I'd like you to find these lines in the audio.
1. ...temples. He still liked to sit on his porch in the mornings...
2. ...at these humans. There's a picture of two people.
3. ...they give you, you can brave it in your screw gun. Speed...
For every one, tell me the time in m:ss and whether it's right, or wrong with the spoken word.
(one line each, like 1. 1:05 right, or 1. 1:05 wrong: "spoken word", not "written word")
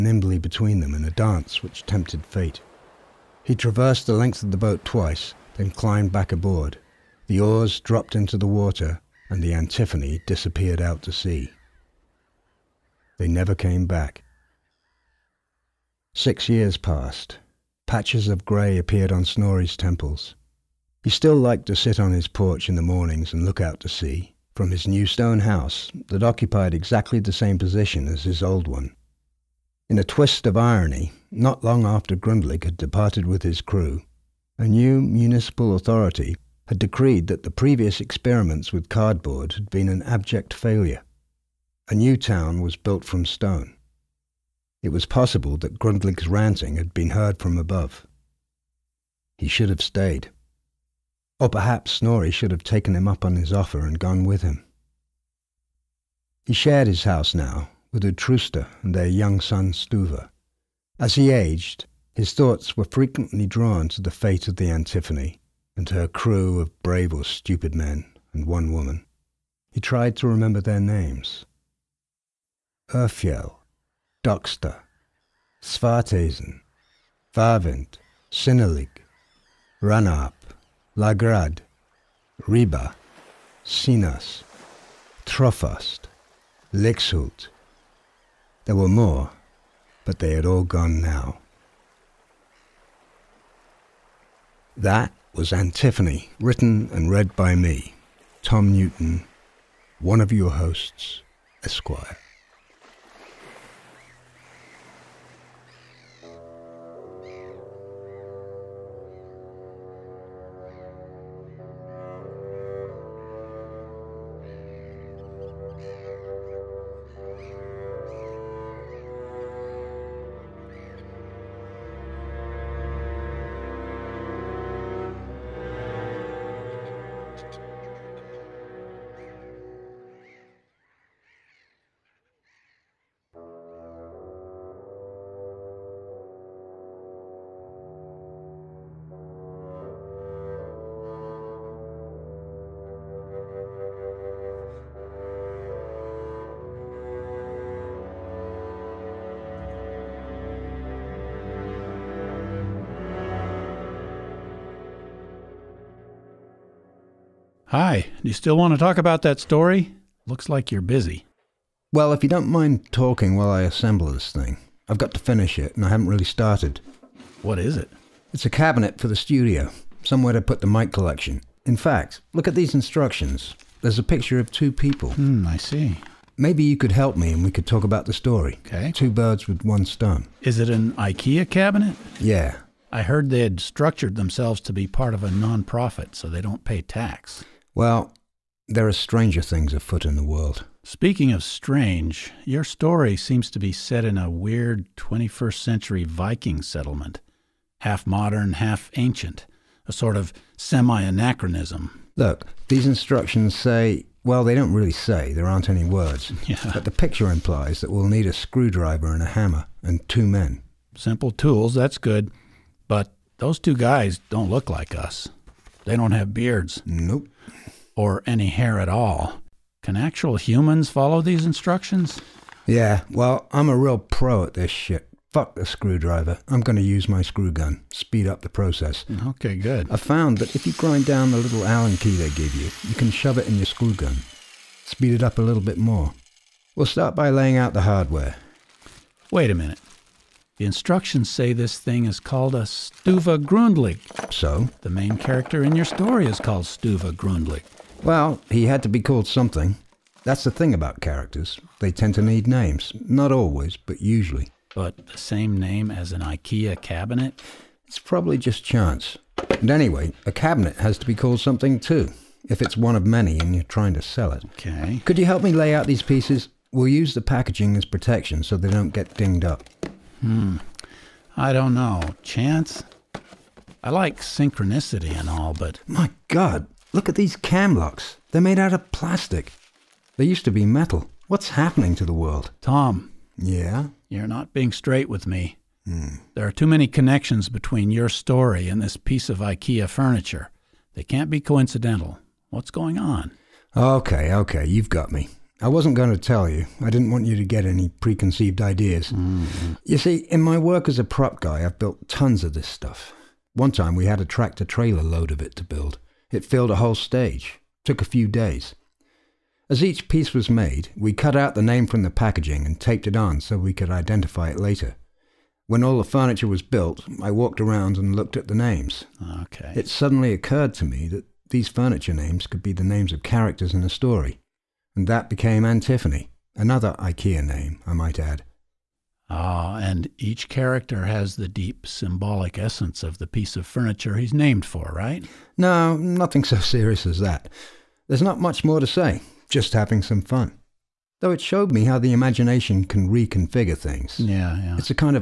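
1. 0:19 right
2. 2:52 wrong: "instructions", not "humans"
3. 3:52 wrong: "shove", not "brave".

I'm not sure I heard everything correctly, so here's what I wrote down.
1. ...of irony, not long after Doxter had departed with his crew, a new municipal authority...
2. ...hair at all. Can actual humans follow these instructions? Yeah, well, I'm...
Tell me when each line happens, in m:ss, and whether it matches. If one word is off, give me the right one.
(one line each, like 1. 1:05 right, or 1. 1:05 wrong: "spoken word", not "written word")
1. 0:30 wrong: "Grundlig", not "Doxter"
2. 3:38 right.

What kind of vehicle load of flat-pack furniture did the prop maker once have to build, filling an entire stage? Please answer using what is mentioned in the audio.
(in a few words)
tractor trailer.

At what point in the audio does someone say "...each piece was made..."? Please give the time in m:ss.
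5:09.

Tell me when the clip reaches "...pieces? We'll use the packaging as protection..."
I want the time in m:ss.
4:26.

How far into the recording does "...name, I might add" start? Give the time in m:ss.
5:27.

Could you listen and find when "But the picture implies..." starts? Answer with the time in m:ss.
3:26.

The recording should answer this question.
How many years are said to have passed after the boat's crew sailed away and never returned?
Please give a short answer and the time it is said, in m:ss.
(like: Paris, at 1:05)
6, at 0:16.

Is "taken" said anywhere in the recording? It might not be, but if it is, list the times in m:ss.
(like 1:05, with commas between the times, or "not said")
0:52.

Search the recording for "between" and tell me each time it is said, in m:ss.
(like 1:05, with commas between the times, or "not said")
0:00, 4:47.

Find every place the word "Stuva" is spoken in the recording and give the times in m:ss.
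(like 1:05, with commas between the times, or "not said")
0:59, 4:02, 4:06.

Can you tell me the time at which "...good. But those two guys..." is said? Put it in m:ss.
3:31.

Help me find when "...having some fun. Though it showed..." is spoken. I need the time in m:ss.
5:39.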